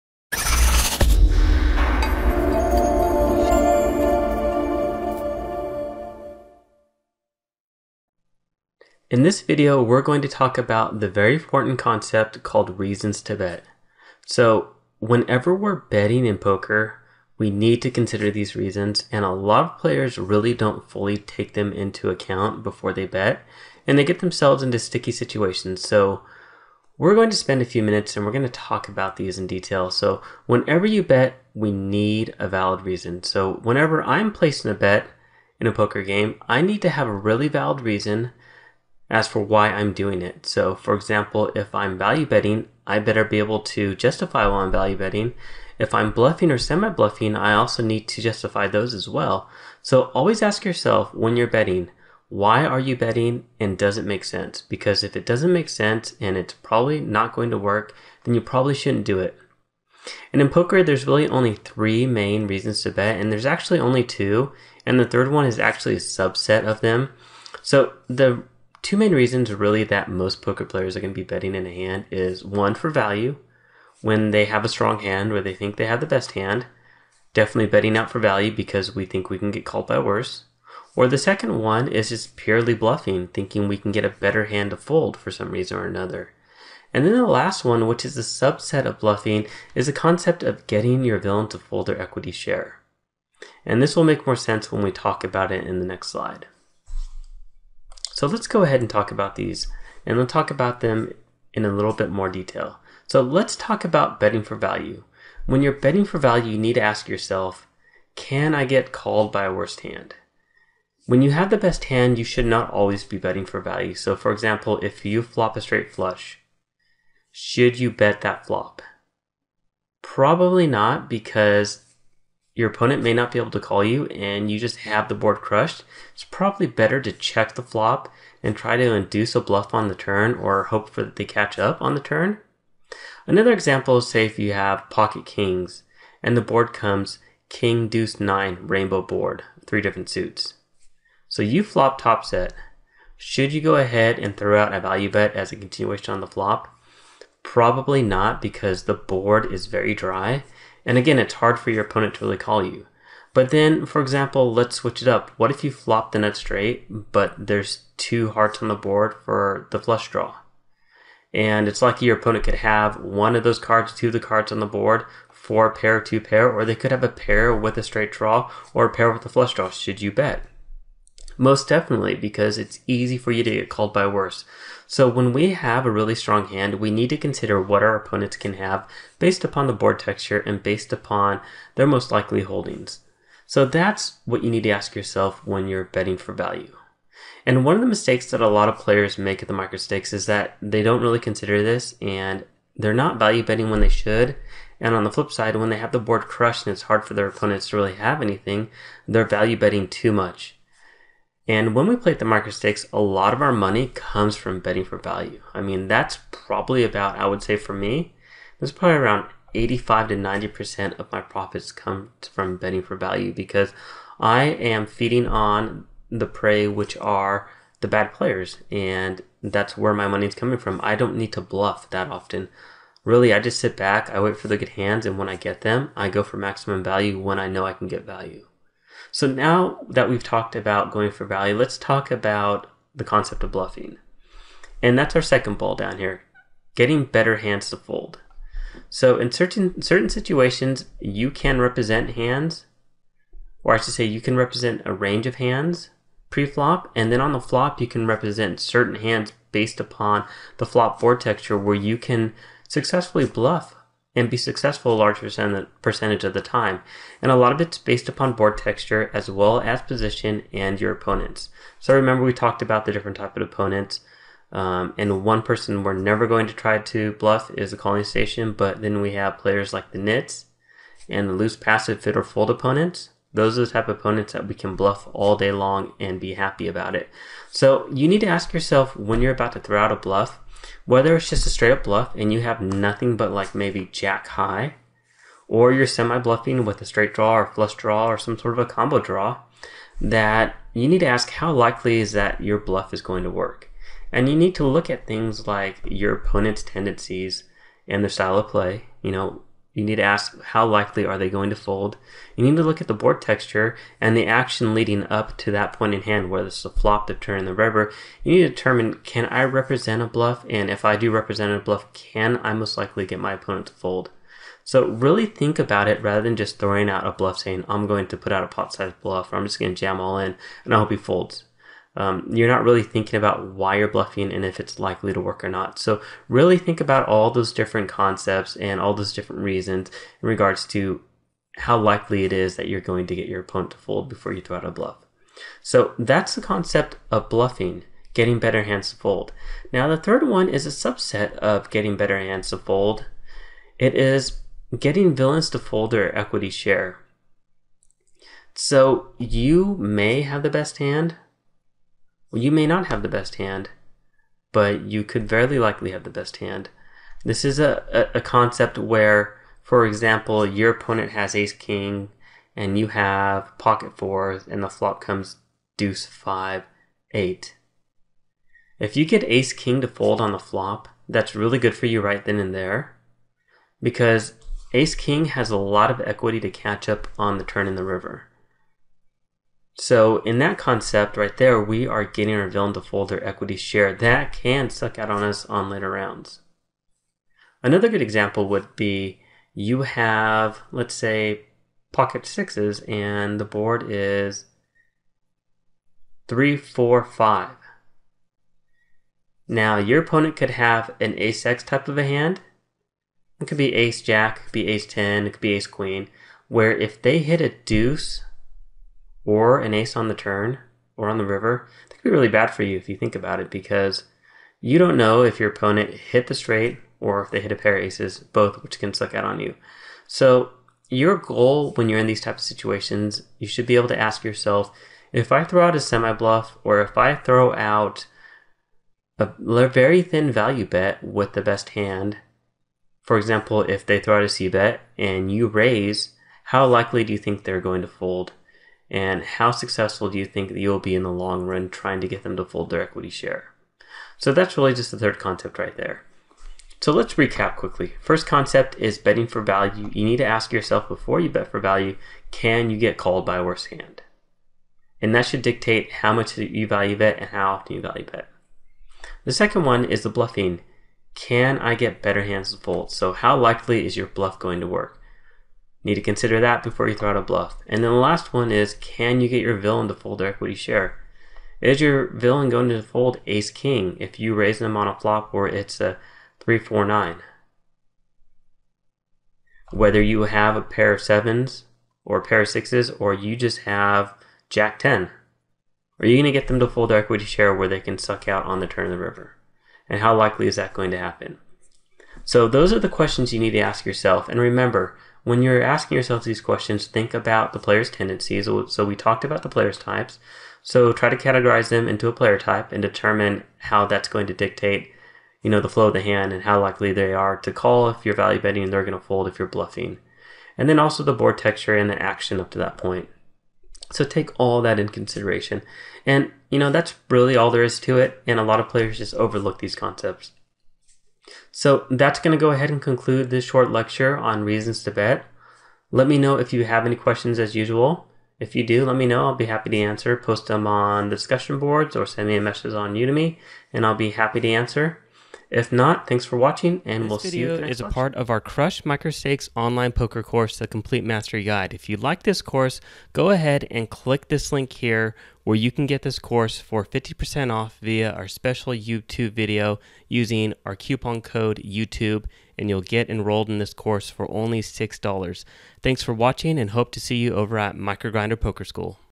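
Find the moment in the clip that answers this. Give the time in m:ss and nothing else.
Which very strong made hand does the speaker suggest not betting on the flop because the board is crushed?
1:55.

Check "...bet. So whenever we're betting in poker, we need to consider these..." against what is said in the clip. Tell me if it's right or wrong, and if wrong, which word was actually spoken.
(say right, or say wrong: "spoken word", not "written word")
right.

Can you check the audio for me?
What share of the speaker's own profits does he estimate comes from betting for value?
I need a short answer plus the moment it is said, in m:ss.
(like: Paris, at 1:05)
85 to 90%, at 3:29.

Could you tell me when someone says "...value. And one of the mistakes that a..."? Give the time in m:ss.
3:06.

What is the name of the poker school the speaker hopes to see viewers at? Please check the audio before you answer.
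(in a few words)
Microgrinder Poker School.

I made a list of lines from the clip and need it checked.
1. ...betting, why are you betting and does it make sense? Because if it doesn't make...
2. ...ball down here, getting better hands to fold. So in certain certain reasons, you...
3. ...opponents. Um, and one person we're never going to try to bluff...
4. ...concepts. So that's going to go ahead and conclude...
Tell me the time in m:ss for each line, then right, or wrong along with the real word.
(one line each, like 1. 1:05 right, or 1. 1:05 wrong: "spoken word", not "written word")
1. 0:51 right
2. 3:55 wrong: "situations", not "reasons"
3. 4:23 right
4. 8:39 right.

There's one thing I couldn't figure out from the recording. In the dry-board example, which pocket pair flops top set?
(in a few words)
Pocket kings.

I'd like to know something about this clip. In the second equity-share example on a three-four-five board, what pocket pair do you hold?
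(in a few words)
Pocket sixes.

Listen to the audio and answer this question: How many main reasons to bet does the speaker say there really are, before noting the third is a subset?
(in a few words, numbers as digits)
2.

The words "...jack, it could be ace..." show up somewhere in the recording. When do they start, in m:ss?
6:44.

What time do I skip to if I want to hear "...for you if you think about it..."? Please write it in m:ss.
6:52.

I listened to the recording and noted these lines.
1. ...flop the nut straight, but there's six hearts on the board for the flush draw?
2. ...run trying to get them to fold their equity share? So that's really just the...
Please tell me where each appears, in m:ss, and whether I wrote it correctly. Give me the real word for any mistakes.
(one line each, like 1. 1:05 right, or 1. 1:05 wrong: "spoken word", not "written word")
1. 2:35 wrong: "two", not "six"
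2. 7:21 right.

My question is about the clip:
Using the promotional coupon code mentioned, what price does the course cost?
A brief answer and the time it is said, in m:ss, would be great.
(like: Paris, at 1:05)
$6, at 9:14.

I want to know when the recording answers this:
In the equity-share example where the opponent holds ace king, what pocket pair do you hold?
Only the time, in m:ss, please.
6:03.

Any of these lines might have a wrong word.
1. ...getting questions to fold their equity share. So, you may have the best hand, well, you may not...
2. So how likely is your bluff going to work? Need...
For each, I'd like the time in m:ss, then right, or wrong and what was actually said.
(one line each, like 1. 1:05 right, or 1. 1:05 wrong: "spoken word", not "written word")
1. 5:44 wrong: "villains", not "questions"
2. 7:42 right.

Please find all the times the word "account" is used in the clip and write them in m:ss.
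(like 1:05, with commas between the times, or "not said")
0:22.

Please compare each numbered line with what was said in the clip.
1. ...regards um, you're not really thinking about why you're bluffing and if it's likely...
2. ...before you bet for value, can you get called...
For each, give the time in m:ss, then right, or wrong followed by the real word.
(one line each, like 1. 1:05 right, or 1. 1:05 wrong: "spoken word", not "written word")
1. 5:20 wrong: "folds", not "regards"
2. 7:30 right.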